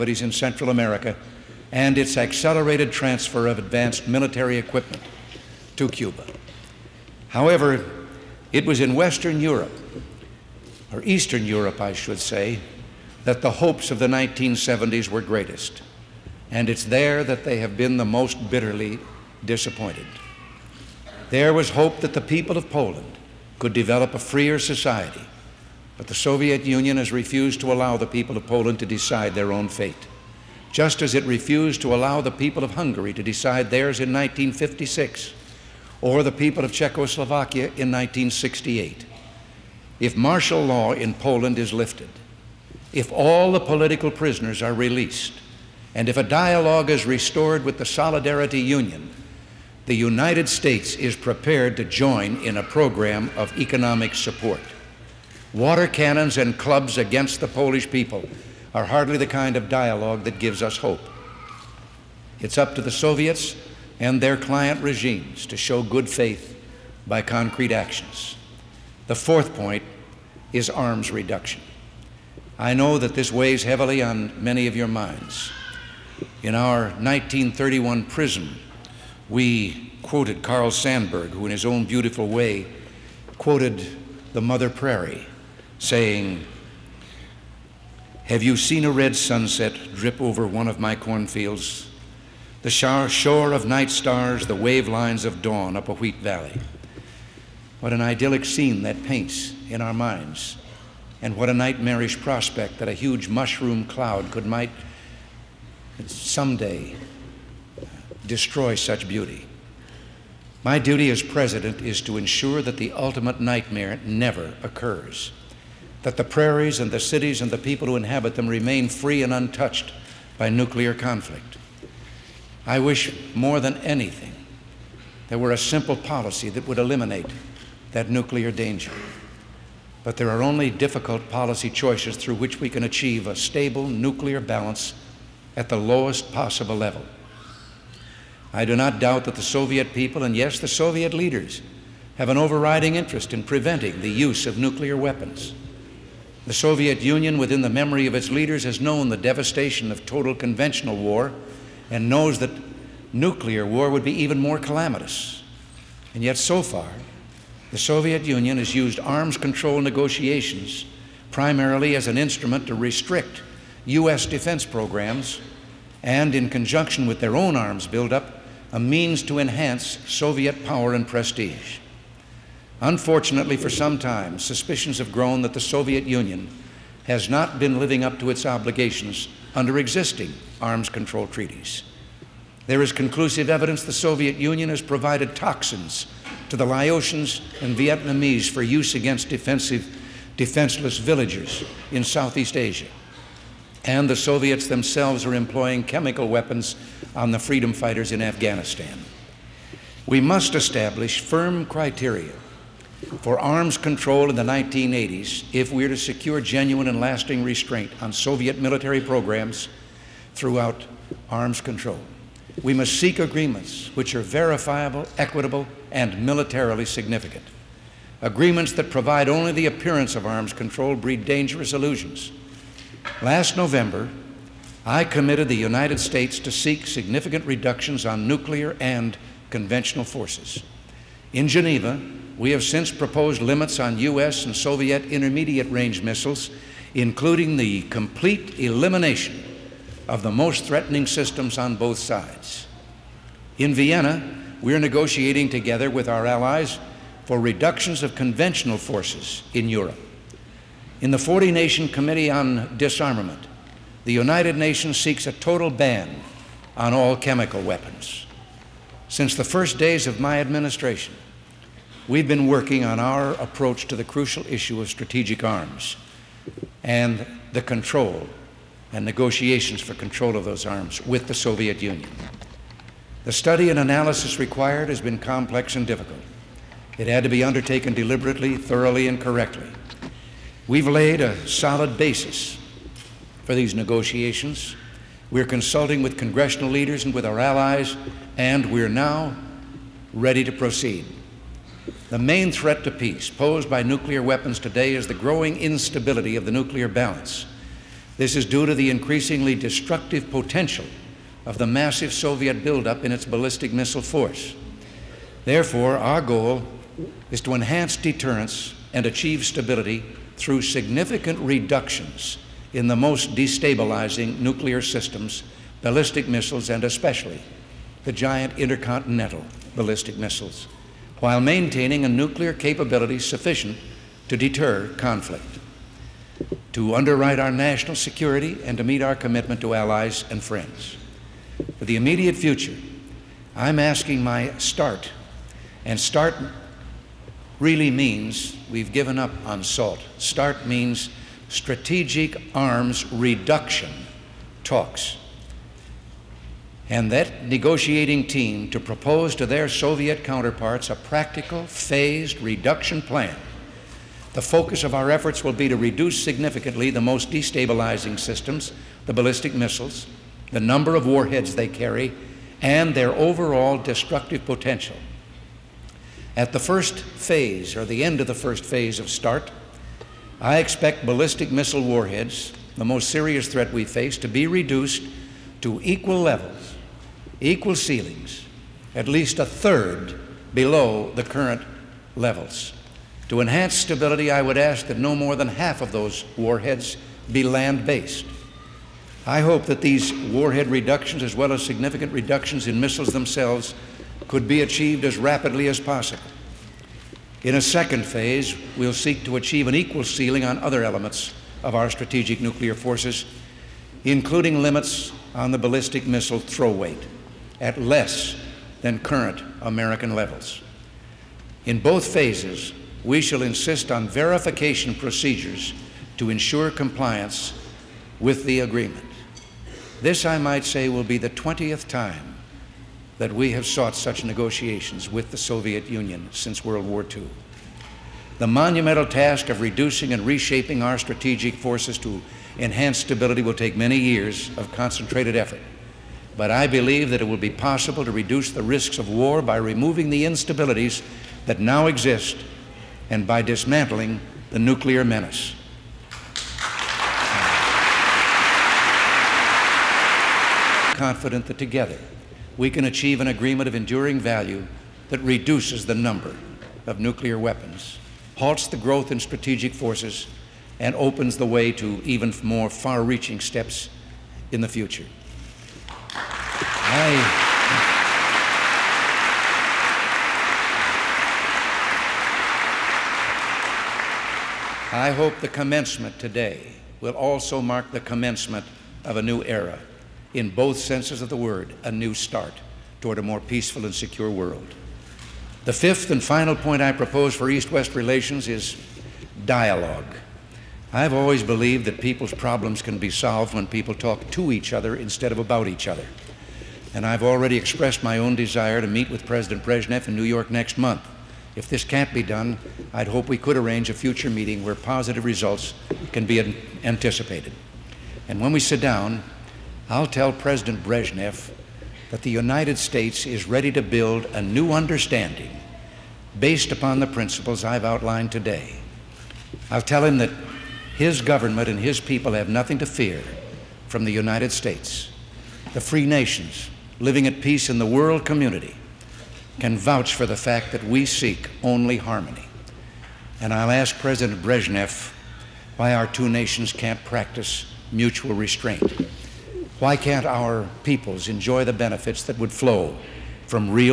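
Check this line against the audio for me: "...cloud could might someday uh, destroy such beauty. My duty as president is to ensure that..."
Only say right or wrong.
right.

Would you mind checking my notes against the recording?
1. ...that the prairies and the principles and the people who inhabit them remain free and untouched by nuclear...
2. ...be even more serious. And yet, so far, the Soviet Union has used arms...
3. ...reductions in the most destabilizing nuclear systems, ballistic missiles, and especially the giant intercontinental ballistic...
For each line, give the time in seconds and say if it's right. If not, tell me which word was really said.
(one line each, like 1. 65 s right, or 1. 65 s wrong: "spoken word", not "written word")
1. 116 s wrong: "cities", not "principles"
2. 154 s wrong: "calamitous", not "serious"
3. 311 s right.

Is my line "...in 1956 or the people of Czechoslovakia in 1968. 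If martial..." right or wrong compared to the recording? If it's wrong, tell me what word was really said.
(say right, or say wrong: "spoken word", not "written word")
right.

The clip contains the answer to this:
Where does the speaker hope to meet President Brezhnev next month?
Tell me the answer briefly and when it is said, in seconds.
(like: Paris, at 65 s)
New York, at 500 s.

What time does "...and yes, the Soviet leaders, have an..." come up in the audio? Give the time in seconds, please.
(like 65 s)
140 s.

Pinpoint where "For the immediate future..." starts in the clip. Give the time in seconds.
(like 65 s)
331 s.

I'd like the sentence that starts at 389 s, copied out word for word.
I hope that these warhead reductions, as well as significant reductions in missiles themselves, could be achieved as rapidly as possible.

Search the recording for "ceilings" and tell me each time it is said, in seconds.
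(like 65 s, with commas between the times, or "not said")
377 s, 400 s.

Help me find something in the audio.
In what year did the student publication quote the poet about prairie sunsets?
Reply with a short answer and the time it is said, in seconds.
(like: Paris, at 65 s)
1931, at 76 s.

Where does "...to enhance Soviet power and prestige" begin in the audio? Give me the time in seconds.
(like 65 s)
169 s.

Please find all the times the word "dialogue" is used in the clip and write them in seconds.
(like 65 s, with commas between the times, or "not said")
46 s, 59 s, 489 s.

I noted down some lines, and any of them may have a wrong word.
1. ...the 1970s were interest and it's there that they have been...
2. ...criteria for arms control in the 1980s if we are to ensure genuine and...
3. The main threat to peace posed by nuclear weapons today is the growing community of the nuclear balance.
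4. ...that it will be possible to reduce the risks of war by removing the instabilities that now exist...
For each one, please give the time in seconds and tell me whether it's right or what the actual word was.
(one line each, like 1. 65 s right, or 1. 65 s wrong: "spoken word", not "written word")
1. 13 s wrong: "greatest", not "interest"
2. 201 s wrong: "secure", not "ensure"
3. 292 s wrong: "instability", not "community"
4. 437 s right.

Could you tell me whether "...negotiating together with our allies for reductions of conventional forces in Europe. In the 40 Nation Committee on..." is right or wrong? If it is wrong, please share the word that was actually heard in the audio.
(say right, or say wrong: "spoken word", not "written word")
right.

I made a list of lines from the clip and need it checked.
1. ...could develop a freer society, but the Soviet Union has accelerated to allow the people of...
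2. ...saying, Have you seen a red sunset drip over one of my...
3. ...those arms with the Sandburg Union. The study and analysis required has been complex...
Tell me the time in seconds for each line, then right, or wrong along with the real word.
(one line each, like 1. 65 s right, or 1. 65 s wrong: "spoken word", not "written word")
1. 23 s wrong: "refused", not "accelerated"
2. 85 s right
3. 270 s wrong: "Soviet", not "Sandburg".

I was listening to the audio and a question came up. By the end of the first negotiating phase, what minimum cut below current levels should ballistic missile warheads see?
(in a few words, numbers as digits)
a third.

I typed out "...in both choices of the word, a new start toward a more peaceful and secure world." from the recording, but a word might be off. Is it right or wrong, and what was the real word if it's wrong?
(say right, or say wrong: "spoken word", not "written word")
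wrong: "senses", not "choices".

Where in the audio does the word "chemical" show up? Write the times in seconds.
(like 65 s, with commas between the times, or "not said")
195 s, 257 s.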